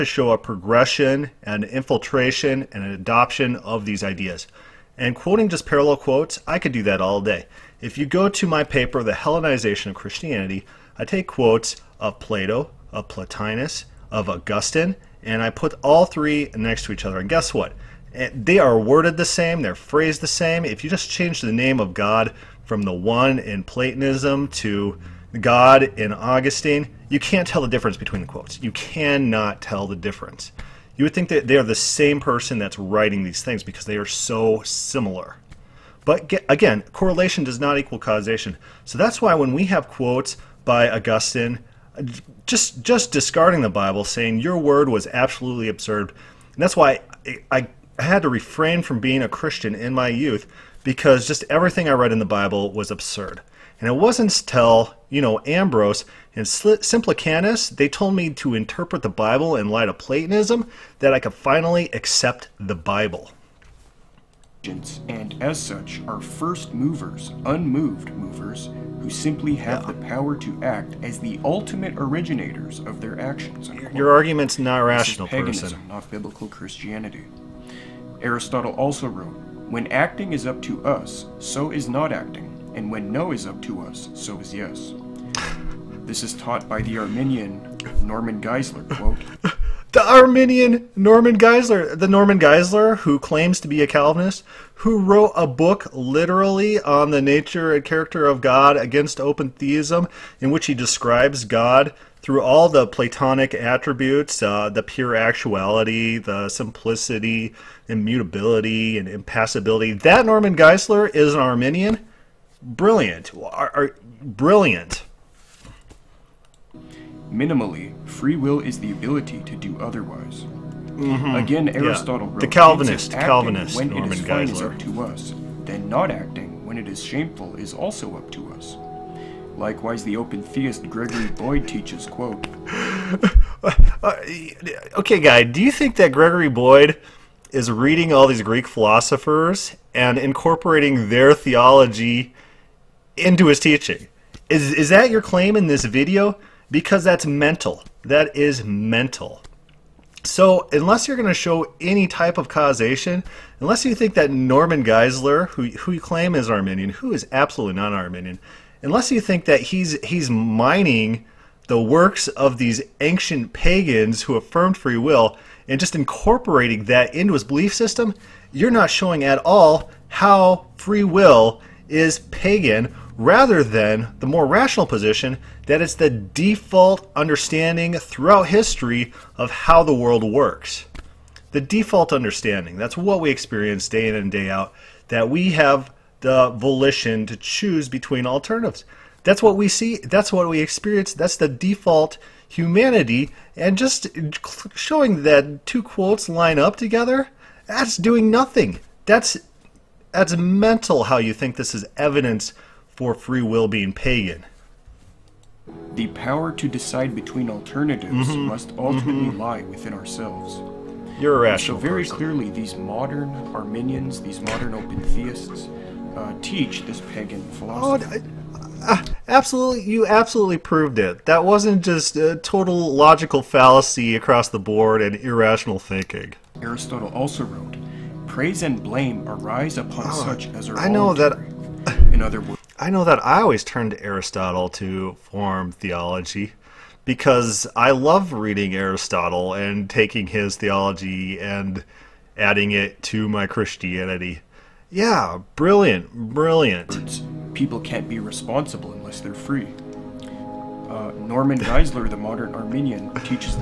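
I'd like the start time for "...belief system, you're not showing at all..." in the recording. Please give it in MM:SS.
02:47.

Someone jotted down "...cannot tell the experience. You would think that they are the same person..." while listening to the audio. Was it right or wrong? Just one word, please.
wrong.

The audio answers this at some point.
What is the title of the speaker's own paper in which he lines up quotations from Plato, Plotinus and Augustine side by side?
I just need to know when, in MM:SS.
00:09.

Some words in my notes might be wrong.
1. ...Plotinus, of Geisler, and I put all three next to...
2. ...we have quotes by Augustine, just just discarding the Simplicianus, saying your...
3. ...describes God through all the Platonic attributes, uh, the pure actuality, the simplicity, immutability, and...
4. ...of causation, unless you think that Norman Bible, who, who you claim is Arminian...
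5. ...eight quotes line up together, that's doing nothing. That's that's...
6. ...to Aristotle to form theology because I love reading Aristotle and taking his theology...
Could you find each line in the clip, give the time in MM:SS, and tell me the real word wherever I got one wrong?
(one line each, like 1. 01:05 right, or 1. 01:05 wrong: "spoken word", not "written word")
1. 00:13 wrong: "Augustine", not "Geisler"
2. 00:39 wrong: "Bible", not "Simplicianus"
3. 01:40 right
4. 02:32 wrong: "Geisler", not "Bible"
5. 03:15 wrong: "two", not "eight"
6. 03:53 right.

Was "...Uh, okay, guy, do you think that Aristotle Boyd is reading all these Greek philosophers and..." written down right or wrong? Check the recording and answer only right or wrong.
wrong.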